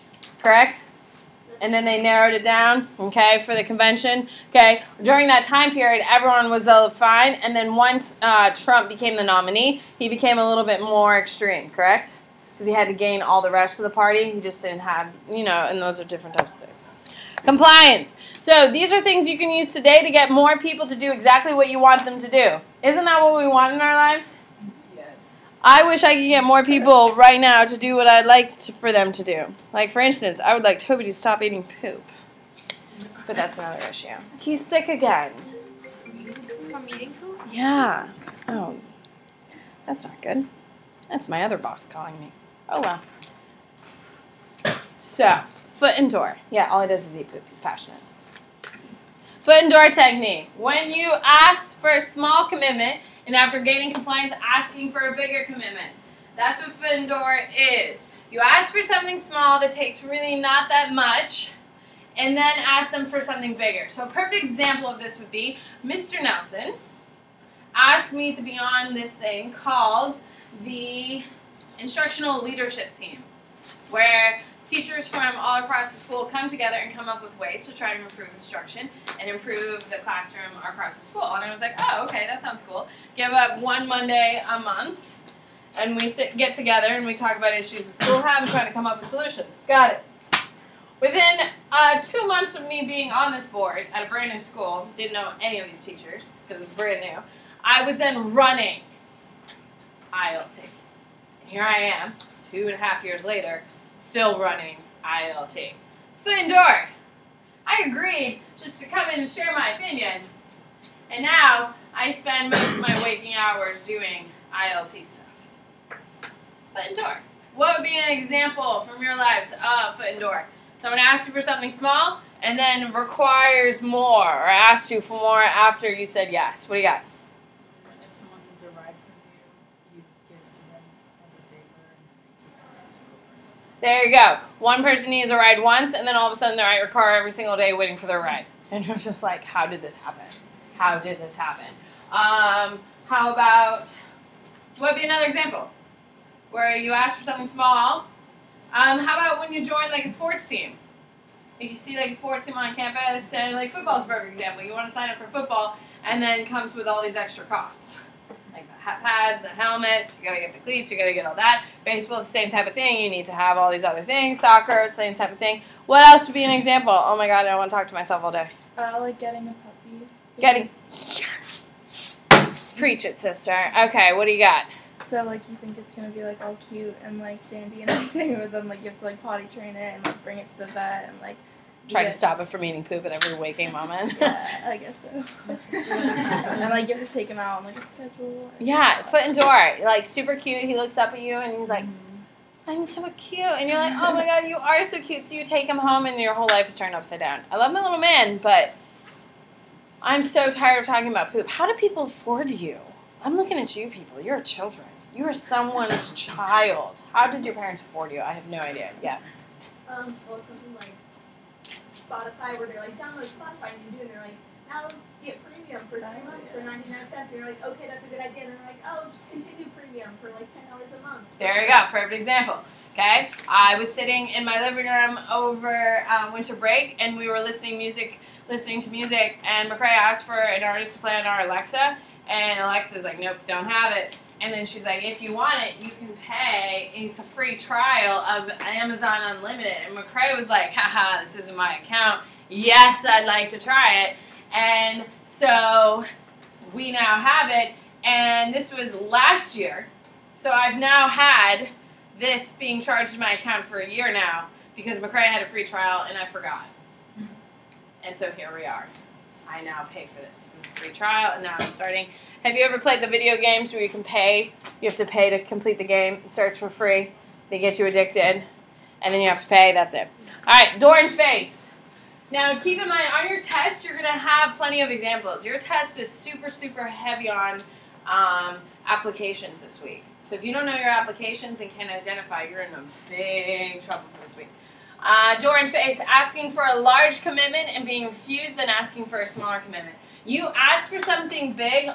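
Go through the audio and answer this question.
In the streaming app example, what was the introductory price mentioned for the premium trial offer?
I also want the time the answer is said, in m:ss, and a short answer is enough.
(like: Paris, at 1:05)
99 cents, at 3:36.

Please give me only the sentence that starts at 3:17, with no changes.
I love my little man, but I'm so tired of talking about poop.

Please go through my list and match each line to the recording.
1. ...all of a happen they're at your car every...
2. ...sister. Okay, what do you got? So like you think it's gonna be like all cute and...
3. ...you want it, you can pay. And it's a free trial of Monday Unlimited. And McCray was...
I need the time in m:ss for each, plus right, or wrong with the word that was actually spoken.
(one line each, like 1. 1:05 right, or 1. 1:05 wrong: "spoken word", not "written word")
1. 2:16 wrong: "sudden", not "happen"
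2. 2:53 right
3. 3:55 wrong: "Amazon", not "Monday".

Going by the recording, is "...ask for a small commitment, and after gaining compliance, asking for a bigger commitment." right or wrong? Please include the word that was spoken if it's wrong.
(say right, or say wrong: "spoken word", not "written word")
right.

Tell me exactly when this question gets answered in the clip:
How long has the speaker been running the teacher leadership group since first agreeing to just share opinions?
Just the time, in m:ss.
1:42.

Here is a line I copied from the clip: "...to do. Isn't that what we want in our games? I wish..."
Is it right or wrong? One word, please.
wrong.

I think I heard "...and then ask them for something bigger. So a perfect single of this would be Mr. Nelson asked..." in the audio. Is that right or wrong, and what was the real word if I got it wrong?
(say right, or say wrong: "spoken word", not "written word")
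wrong: "example", not "single".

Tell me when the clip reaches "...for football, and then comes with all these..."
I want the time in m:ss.
2:35.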